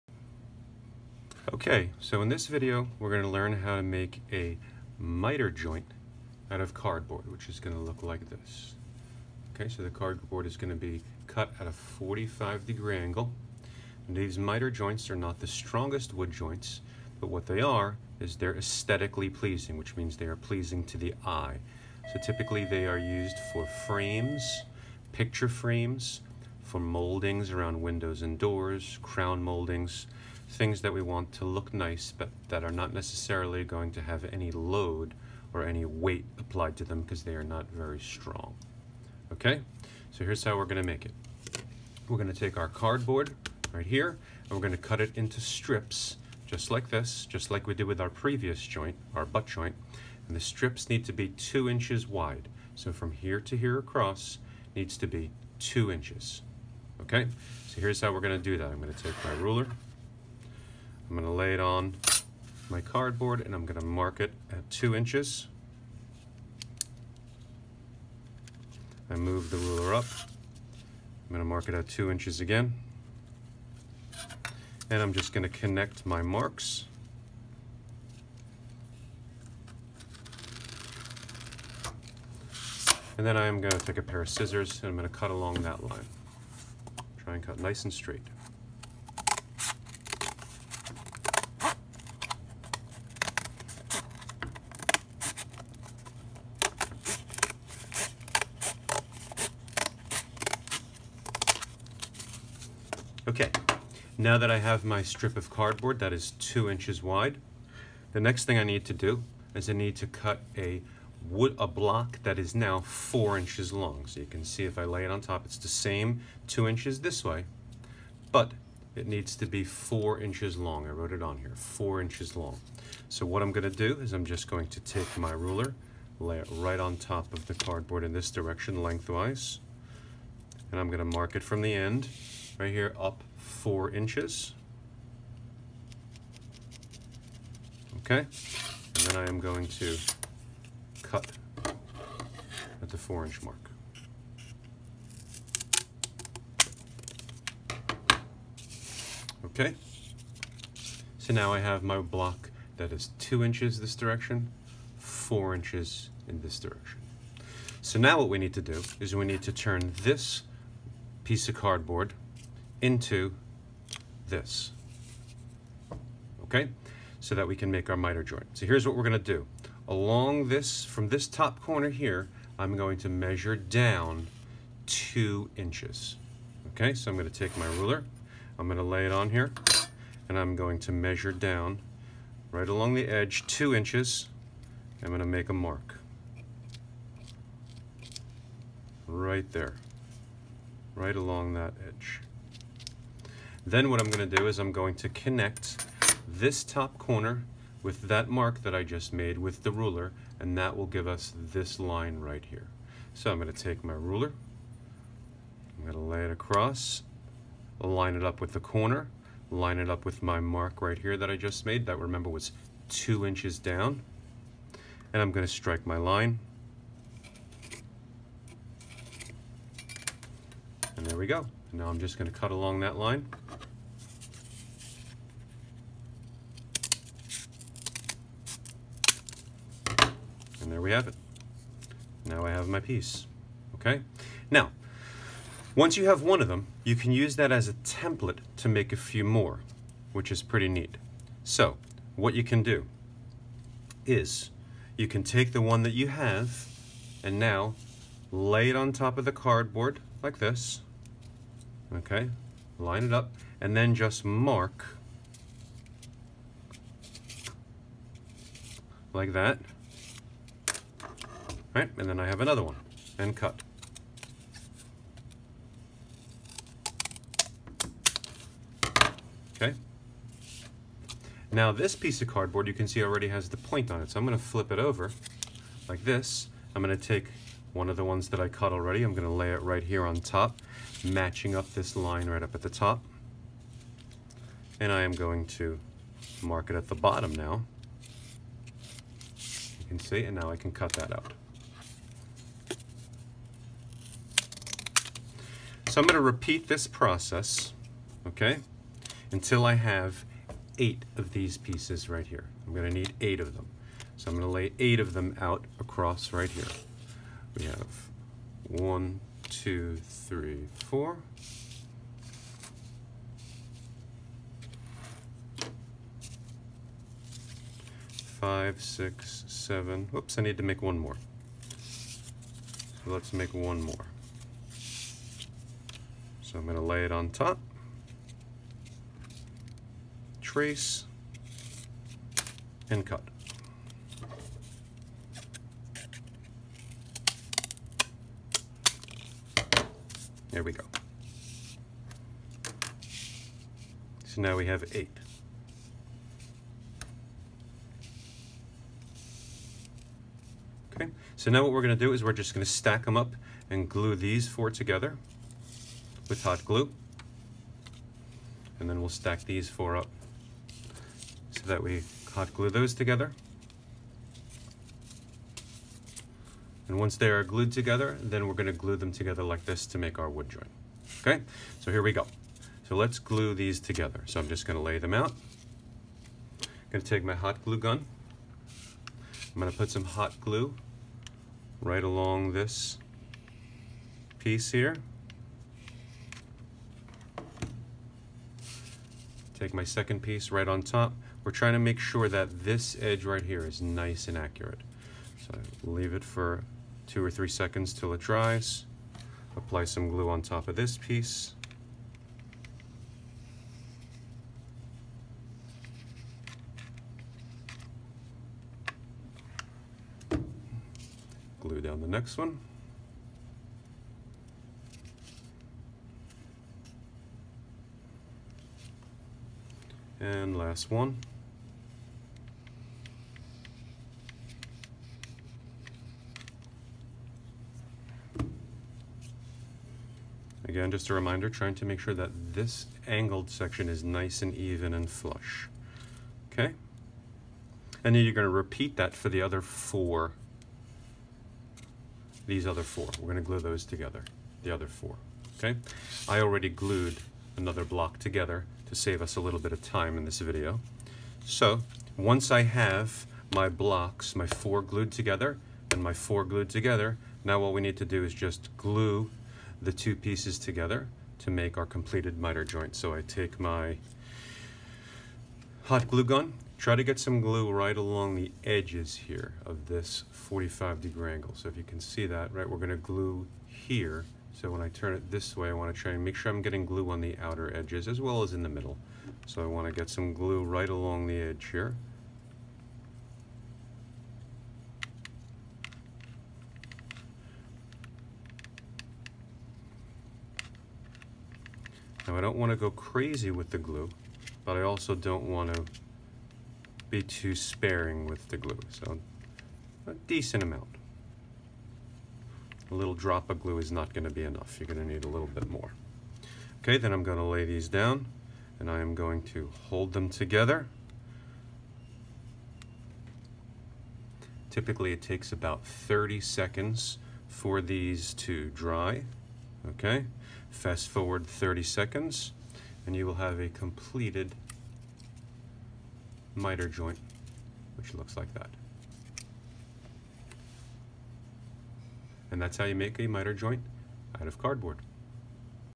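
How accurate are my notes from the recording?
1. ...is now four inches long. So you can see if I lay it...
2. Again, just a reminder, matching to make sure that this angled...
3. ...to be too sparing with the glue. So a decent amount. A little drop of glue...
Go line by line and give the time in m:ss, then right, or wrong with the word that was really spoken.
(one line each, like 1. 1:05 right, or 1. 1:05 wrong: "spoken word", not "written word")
1. 1:52 right
2. 7:10 wrong: "trying", not "matching"
3. 8:15 right.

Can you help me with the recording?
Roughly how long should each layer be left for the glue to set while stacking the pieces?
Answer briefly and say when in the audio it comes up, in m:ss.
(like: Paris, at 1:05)
2 or 3 seconds, at 6:37.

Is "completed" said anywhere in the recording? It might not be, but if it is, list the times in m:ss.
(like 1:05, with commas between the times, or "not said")
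7:41, 8:43.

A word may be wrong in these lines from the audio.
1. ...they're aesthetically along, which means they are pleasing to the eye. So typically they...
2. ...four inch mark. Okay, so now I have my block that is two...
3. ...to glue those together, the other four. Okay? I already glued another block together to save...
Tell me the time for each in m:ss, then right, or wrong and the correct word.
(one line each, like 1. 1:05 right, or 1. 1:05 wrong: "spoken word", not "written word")
1. 0:18 wrong: "pleasing", not "along"
2. 2:22 right
3. 7:23 right.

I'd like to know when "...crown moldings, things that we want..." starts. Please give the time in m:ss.
0:29.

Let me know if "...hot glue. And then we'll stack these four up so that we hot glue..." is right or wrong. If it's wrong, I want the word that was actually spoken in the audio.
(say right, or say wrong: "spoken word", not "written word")
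right.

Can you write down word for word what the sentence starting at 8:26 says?
Okay, then I'm going to lay these down and I am going to hold them together.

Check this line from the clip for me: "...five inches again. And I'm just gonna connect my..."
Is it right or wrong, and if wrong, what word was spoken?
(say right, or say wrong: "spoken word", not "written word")
wrong: "two", not "five".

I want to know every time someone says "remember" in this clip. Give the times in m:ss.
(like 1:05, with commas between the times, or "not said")
3:31.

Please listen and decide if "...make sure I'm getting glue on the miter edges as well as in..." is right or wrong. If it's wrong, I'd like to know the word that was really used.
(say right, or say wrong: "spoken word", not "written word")
wrong: "outer", not "miter".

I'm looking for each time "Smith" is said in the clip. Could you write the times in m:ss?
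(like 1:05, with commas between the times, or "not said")
not said.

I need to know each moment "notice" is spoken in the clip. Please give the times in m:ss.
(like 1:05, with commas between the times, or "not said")
not said.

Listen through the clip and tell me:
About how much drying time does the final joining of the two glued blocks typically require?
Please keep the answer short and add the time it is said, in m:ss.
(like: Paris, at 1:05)
30 seconds, at 8:35.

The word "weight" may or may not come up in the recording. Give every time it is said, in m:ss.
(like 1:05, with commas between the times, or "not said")
0:35.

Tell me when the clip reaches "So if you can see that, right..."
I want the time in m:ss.
7:51.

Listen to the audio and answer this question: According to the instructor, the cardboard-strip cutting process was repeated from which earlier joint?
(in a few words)
butt joint.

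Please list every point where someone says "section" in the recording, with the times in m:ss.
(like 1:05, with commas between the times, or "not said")
7:13.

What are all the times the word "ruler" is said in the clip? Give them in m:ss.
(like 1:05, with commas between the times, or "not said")
0:59, 1:09, 2:05, 2:57, 3:19, 3:23.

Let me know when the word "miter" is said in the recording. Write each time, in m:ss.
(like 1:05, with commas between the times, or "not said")
0:04, 0:14, 2:47, 7:42, 8:46, 8:53.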